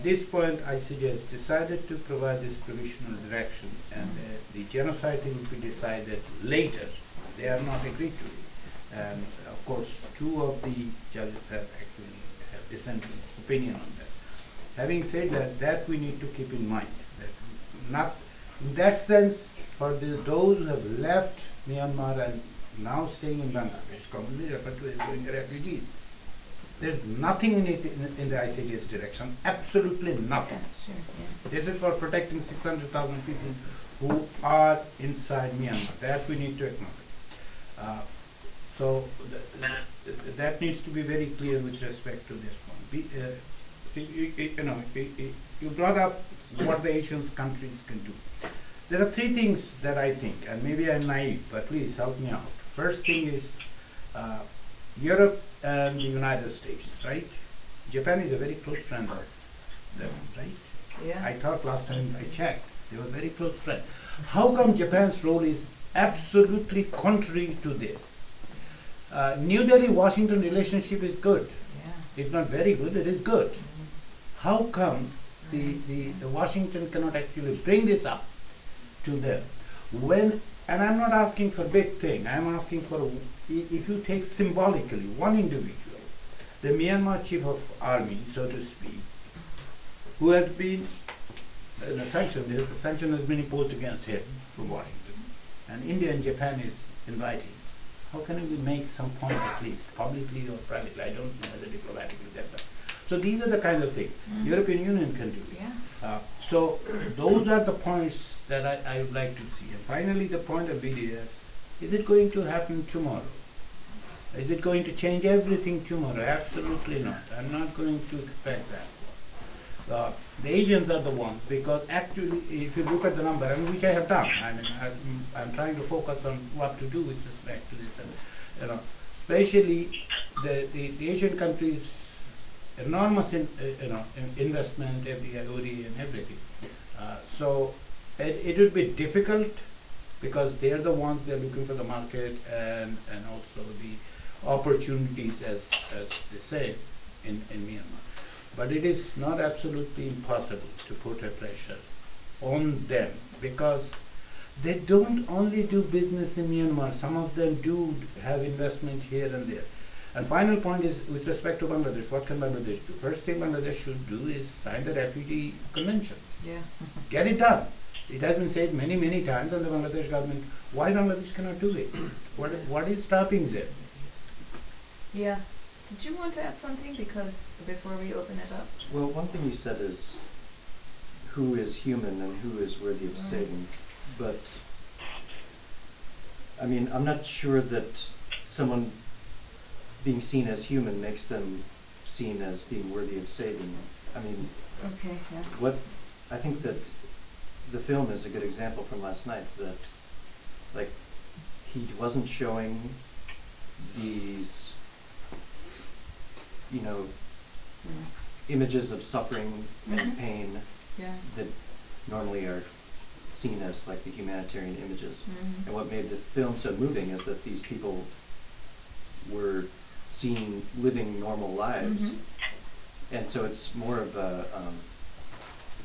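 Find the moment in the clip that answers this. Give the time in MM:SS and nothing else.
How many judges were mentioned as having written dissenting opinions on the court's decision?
00:10.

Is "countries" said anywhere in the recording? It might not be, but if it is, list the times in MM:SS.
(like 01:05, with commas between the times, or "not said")
00:47, 02:11.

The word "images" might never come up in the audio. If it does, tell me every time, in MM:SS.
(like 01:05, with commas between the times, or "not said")
03:28, 03:34.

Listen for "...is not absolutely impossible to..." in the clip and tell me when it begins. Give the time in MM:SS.
02:28.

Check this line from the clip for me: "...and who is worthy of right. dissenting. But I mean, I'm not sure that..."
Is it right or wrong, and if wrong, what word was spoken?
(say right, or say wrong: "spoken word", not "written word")
wrong: "saving", not "dissenting".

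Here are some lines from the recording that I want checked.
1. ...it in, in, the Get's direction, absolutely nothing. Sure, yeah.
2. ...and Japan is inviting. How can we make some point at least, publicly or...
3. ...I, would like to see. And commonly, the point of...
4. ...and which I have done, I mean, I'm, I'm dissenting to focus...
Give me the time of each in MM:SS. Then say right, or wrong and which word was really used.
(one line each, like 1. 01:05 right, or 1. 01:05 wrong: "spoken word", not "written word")
1. 00:27 wrong: "ICJ", not "Get"
2. 01:36 right
3. 01:48 wrong: "finally", not "commonly"
4. 02:03 wrong: "trying", not "dissenting".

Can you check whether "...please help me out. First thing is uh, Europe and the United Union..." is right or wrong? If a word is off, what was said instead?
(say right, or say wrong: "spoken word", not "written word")
wrong: "States", not "Union".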